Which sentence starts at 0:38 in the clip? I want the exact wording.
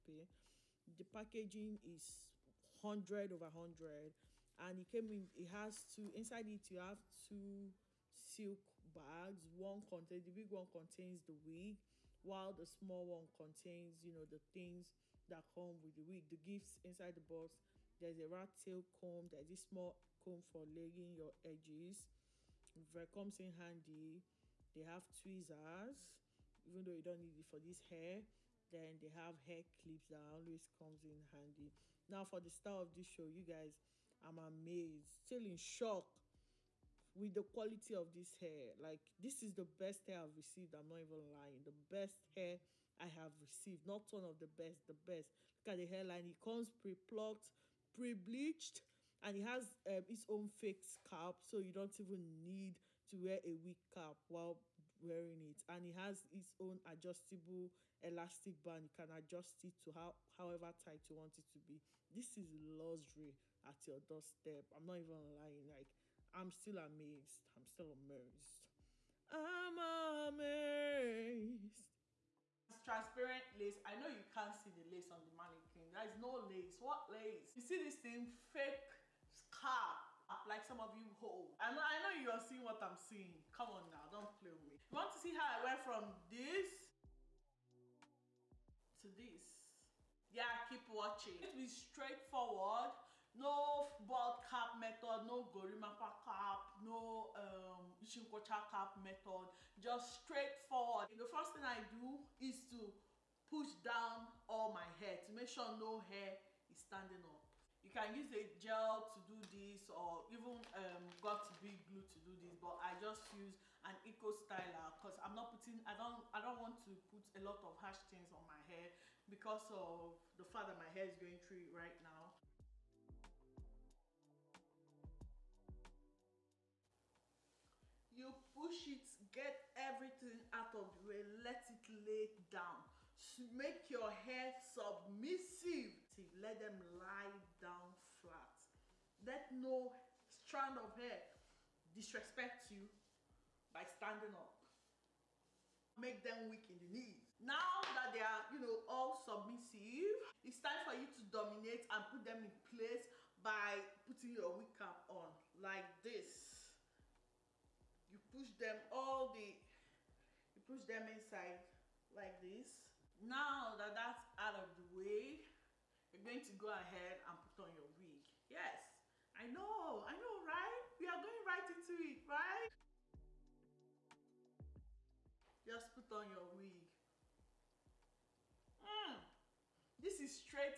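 Like, this is the best hair I've received.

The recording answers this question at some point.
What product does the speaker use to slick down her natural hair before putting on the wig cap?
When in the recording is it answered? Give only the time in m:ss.
1:54.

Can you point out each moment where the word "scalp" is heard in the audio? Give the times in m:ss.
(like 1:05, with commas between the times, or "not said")
0:50, 1:19.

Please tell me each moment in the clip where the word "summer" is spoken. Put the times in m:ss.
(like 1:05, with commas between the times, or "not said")
not said.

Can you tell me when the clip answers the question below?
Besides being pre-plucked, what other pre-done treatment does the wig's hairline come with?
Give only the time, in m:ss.
0:47.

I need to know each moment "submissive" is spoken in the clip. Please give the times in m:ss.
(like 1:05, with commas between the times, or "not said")
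2:14, 2:29.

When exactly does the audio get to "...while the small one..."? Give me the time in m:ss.
0:12.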